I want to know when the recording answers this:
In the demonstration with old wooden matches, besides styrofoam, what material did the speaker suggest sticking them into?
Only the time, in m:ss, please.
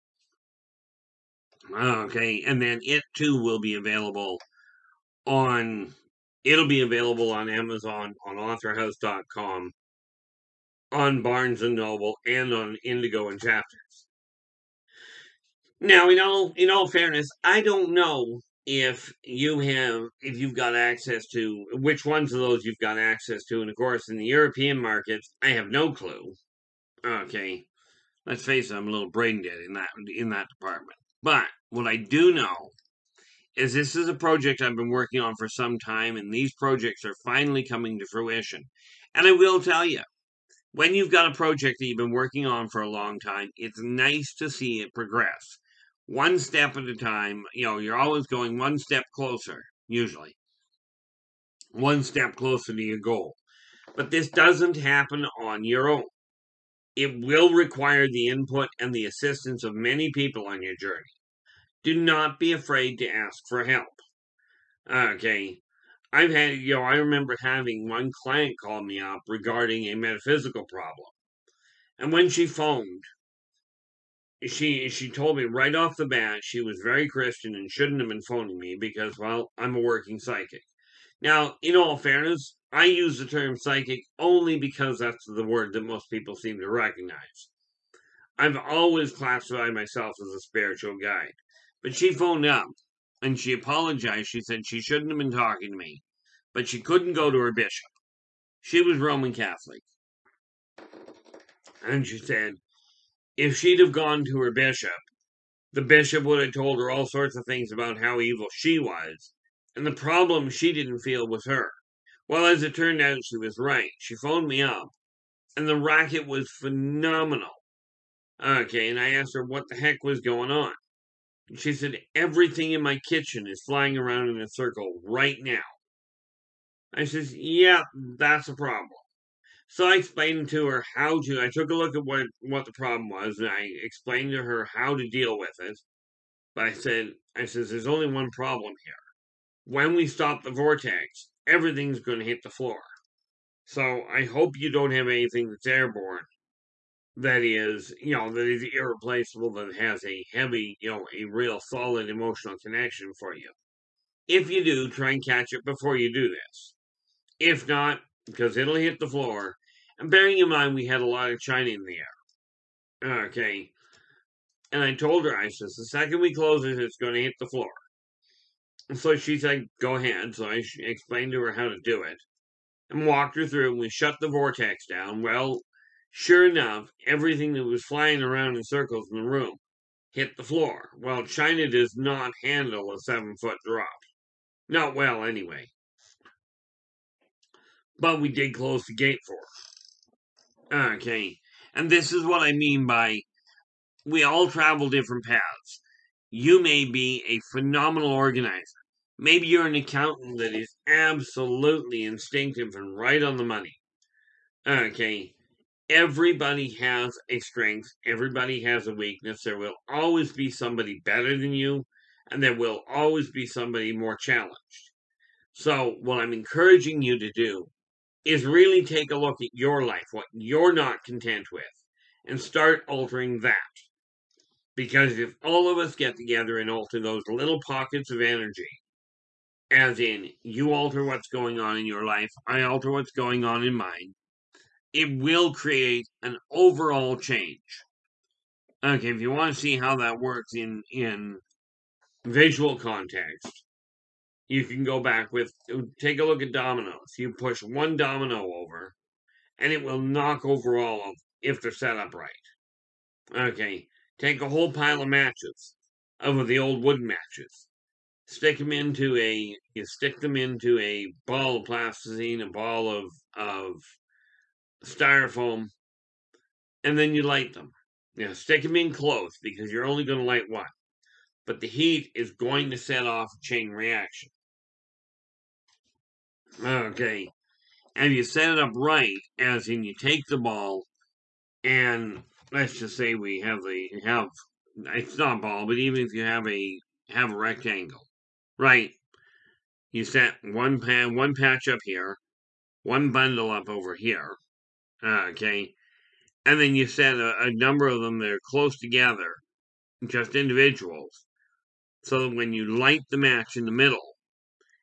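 4:21.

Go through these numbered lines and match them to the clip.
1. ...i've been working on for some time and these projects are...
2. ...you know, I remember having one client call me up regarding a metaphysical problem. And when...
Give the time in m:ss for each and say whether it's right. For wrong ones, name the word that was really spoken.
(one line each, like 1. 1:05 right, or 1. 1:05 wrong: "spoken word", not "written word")
1. 0:34 right
2. 1:06 right.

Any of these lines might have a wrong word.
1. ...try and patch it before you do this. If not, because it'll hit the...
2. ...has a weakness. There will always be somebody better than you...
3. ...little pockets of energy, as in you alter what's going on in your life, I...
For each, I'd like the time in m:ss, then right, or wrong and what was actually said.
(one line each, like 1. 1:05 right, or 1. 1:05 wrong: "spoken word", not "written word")
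1. 2:34 wrong: "catch", not "patch"
2. 3:28 right
3. 3:47 right.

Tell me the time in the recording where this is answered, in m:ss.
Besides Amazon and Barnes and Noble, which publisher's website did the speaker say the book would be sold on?
0:08.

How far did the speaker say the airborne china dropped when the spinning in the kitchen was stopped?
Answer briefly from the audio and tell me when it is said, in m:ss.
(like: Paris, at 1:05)
7 feet, at 3:02.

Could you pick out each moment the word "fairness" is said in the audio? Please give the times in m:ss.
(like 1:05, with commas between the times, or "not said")
0:16, 1:21.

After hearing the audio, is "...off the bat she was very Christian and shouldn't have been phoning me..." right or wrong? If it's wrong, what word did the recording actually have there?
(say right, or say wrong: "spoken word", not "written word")
right.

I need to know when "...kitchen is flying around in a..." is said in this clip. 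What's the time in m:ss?
2:03.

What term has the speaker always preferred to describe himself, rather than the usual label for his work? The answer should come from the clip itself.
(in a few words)
spiritual guide.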